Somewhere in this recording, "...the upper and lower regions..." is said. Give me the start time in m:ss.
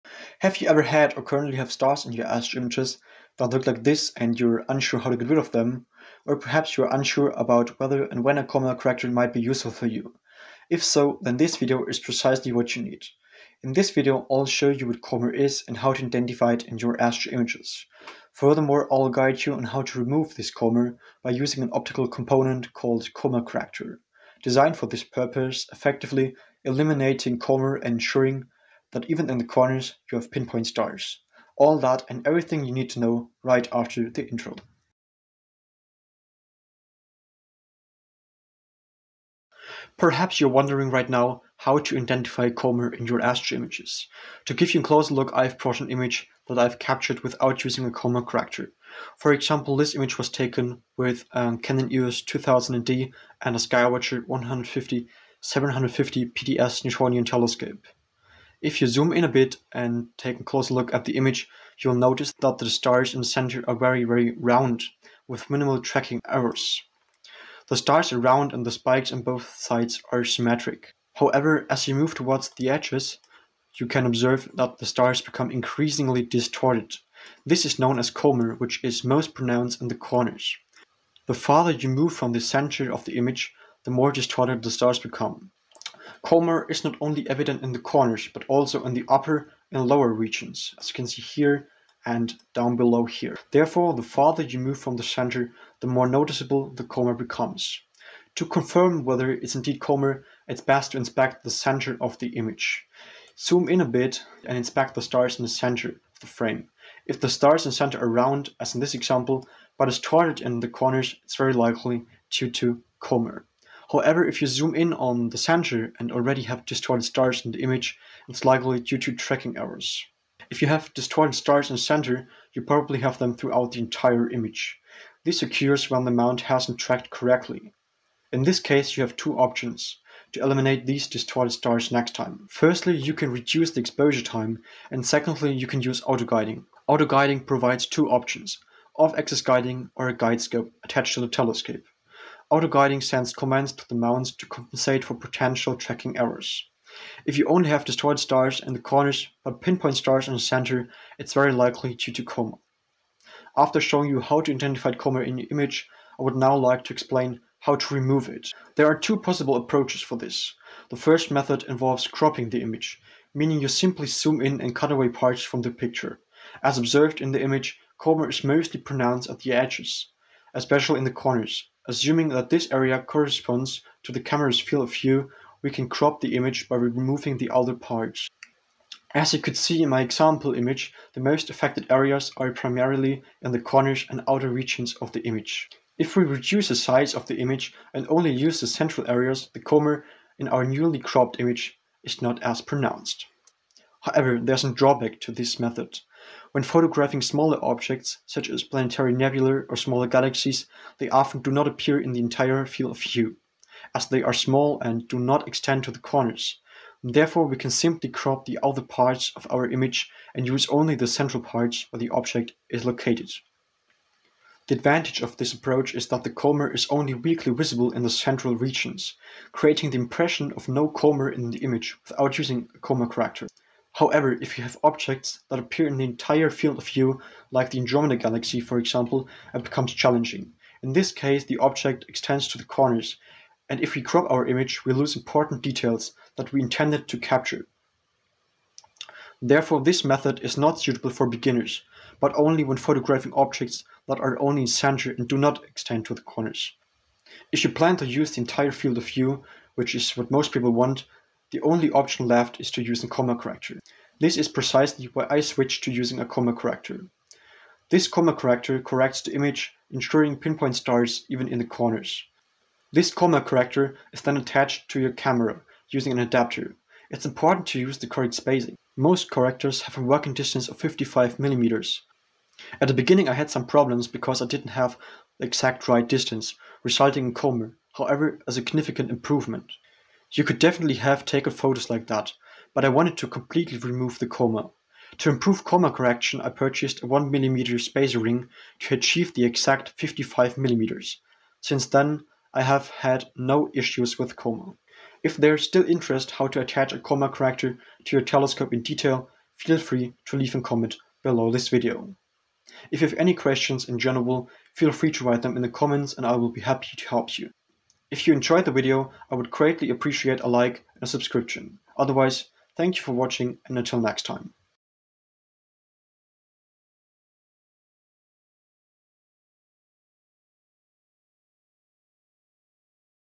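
1:28.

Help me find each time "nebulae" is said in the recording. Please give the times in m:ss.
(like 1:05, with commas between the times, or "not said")
3:19.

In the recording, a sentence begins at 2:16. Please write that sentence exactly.
Auto-guiding provides two options, off-axis guiding or a guide scope attached to the telescope.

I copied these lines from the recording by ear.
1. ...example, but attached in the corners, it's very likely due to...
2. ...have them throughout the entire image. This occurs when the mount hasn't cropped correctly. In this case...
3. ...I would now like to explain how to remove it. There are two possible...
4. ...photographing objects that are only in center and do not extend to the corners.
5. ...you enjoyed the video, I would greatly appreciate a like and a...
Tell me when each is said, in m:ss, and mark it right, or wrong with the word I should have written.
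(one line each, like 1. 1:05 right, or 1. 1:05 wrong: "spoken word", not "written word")
1. 1:48 wrong: "distorted", not "attached"
2. 2:03 wrong: "tracked", not "cropped"
3. 2:36 right
4. 4:02 right
5. 5:08 right.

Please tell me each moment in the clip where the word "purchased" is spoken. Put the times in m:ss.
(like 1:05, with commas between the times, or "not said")
4:46.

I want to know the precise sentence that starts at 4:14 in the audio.
This is precisely why I switched to using a coma corrector.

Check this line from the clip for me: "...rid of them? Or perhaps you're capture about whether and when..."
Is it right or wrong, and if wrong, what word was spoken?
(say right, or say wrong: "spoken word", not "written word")
wrong: "unsure", not "capture".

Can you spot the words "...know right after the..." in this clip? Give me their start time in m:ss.
0:32.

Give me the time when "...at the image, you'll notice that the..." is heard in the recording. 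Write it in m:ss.
1:00.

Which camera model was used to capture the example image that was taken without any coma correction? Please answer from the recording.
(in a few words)
Canon EOS 2000D.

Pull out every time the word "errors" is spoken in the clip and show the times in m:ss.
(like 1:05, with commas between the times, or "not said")
1:06, 1:59, 2:26.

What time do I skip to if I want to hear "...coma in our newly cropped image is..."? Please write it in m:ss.
3:09.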